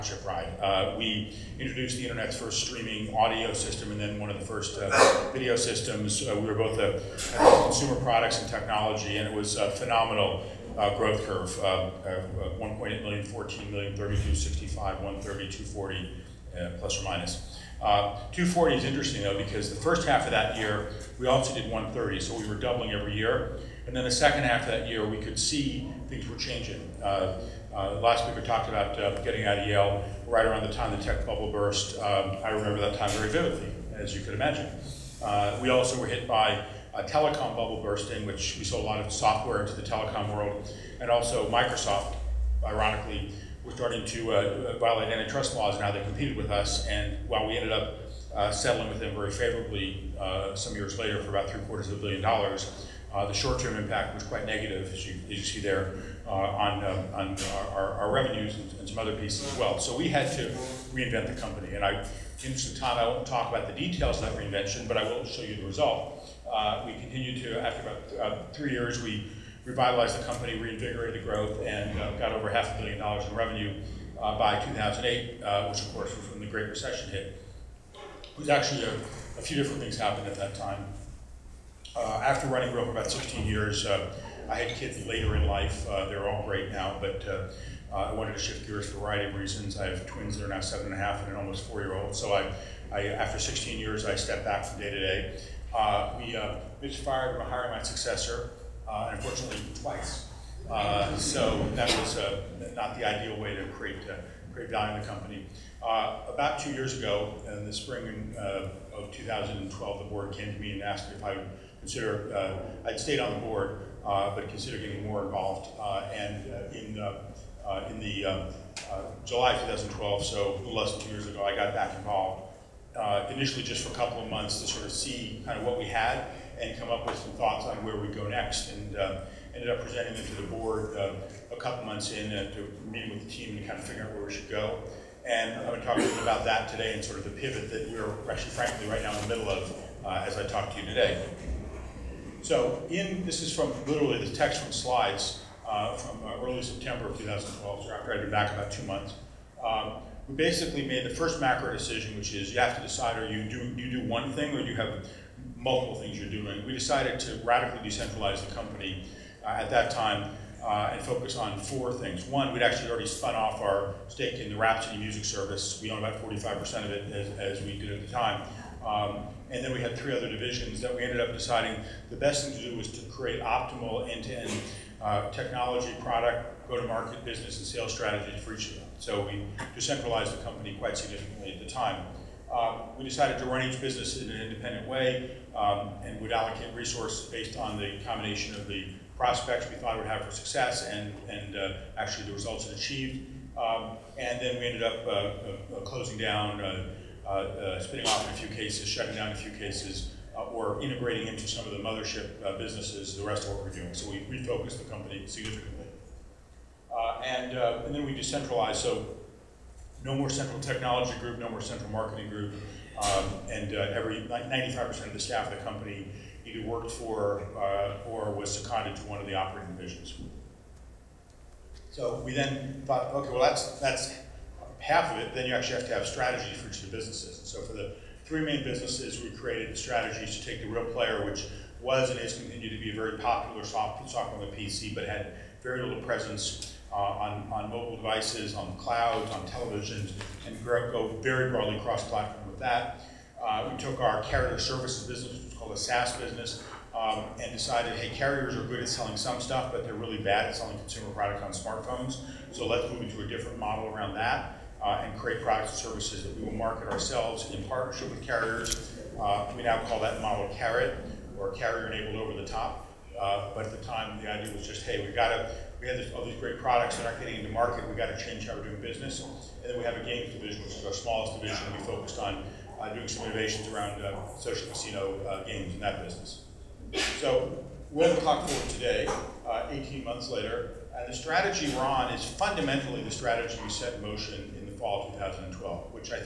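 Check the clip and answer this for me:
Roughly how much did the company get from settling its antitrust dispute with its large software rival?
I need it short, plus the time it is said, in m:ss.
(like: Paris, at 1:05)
three quarters of a billion dollars, at 0:51.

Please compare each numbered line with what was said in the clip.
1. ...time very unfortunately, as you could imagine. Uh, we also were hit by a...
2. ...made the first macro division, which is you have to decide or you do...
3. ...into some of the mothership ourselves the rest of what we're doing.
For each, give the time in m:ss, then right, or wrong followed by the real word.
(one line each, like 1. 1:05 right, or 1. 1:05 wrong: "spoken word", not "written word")
1. 0:32 wrong: "vividly", not "unfortunately"
2. 2:30 wrong: "decision", not "division"
3. 3:21 wrong: "businesses", not "ourselves".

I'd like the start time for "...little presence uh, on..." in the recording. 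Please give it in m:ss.
3:55.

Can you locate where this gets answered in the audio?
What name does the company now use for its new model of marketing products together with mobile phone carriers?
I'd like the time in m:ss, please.
4:21.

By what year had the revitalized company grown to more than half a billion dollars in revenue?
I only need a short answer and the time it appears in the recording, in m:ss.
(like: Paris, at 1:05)
2008, at 1:14.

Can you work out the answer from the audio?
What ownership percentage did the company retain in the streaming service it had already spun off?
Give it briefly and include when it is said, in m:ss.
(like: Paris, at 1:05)
45%, at 2:46.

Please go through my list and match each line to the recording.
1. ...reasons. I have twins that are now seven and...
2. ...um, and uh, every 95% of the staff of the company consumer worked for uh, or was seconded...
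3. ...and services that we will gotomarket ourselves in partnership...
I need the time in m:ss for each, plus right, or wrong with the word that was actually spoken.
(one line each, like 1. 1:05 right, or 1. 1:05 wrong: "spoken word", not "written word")
1. 1:29 right
2. 3:33 wrong: "either", not "consumer"
3. 4:15 wrong: "market", not "gotomarket".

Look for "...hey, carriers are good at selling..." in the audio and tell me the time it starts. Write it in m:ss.
4:07.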